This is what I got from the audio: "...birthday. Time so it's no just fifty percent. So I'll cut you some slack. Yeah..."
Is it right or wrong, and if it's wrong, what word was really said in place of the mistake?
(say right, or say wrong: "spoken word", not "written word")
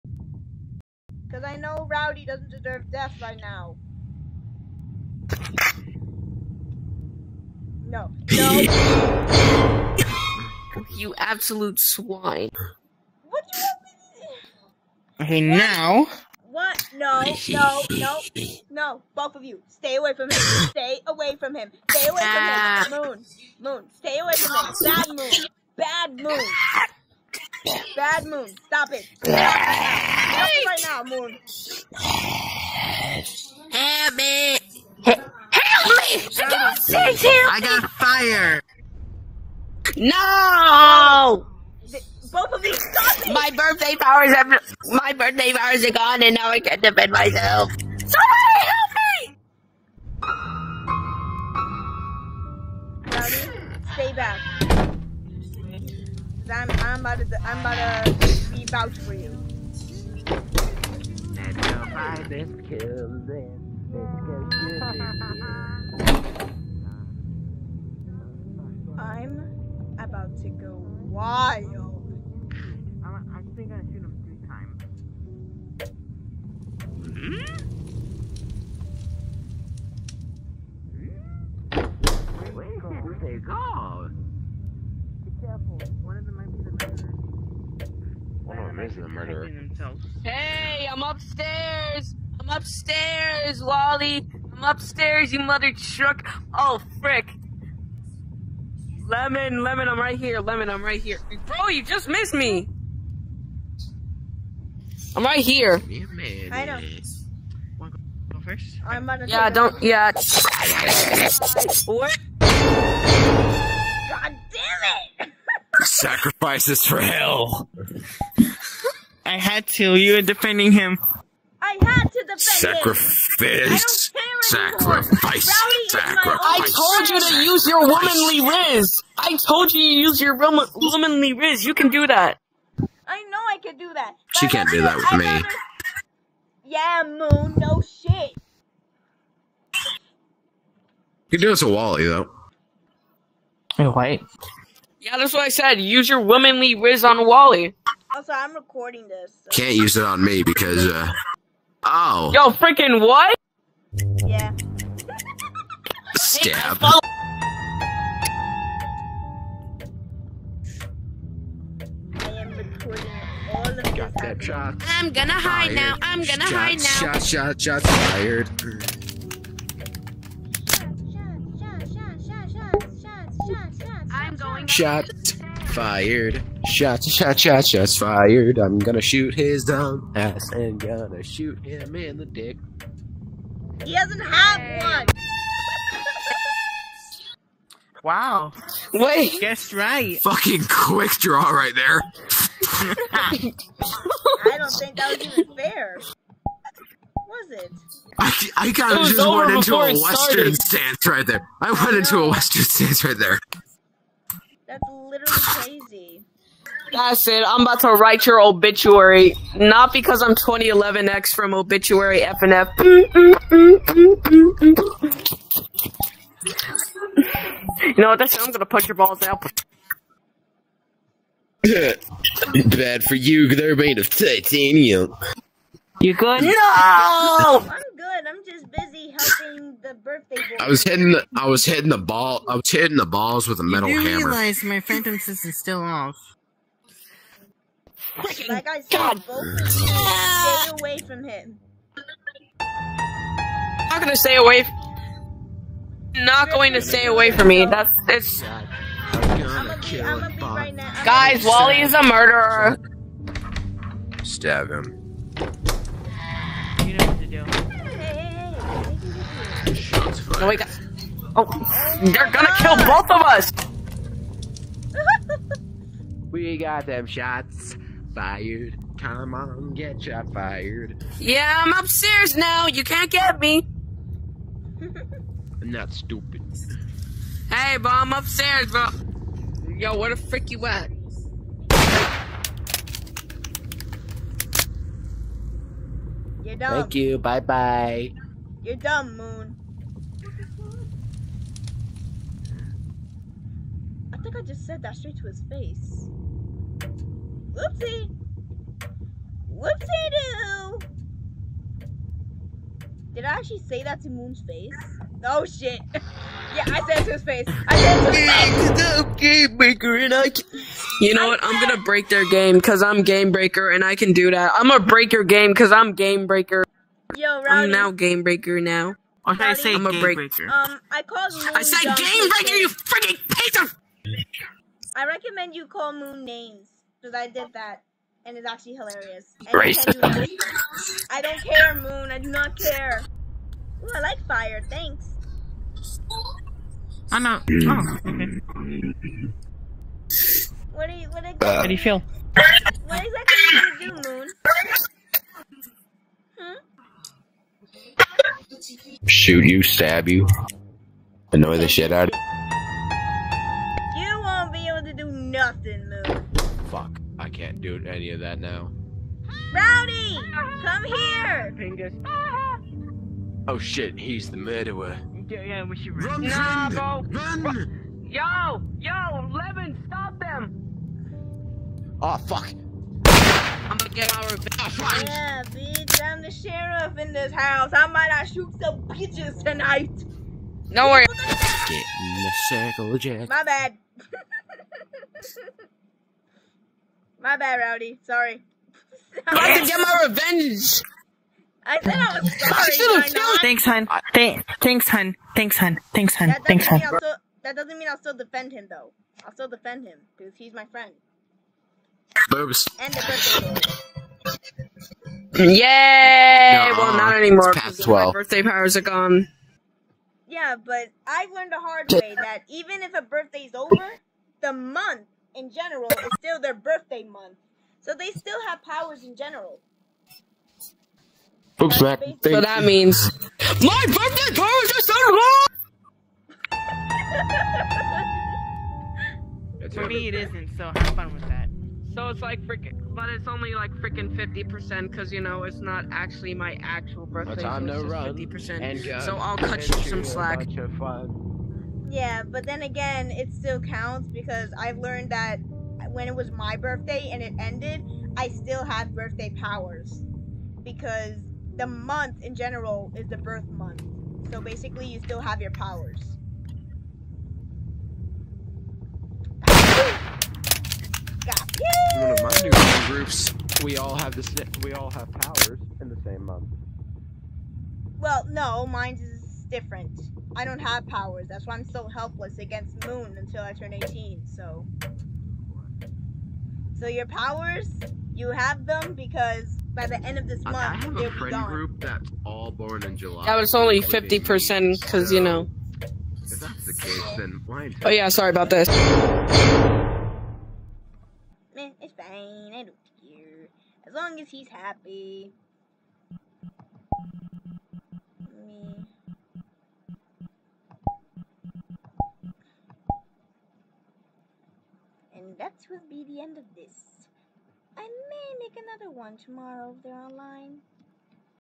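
right.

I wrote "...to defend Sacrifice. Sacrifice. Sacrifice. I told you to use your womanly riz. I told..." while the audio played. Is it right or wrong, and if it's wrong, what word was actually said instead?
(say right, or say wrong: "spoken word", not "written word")
right.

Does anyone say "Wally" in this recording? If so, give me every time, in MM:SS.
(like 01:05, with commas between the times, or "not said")
01:33, 02:21, 02:27, 04:11.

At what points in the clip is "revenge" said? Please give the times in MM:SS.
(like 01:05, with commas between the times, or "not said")
06:14, 06:30.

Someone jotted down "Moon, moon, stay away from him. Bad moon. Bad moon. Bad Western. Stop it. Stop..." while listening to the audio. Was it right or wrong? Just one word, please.
wrong.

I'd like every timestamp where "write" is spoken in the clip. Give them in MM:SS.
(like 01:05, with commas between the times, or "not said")
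03:27.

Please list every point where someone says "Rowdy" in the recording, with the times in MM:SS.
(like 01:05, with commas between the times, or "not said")
00:01, 05:17, 05:59, 06:27.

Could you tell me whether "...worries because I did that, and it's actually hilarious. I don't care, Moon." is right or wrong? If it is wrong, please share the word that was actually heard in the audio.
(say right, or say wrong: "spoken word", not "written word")
wrong: "names", not "worries".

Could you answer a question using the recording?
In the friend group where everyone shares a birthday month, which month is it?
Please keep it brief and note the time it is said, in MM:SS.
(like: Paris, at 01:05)
July, at 08:02.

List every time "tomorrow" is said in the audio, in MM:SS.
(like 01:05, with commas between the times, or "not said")
08:29.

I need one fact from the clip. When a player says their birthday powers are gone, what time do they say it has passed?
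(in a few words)
Twelve.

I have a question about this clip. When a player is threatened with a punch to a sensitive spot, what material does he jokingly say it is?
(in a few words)
Titanium.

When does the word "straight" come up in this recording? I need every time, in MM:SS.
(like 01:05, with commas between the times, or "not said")
04:54.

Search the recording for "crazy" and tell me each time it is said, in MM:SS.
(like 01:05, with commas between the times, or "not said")
03:25.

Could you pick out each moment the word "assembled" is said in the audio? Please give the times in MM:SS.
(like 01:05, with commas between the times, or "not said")
not said.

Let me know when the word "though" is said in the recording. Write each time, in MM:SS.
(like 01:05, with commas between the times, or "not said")
02:22, 06:38.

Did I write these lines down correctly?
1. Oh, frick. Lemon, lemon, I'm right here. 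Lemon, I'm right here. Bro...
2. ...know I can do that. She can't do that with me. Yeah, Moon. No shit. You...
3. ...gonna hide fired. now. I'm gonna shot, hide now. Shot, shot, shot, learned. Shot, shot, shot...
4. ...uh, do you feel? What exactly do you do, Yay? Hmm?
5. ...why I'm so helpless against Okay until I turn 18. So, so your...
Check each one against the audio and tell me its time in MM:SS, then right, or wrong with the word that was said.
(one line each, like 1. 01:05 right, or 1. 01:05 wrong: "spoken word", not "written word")
1. 01:36 right
2. 02:13 right
3. 02:45 wrong: "fired", not "learned"
4. 05:41 wrong: "Moon", not "Yay"
5. 07:51 wrong: "Moon", not "Okay".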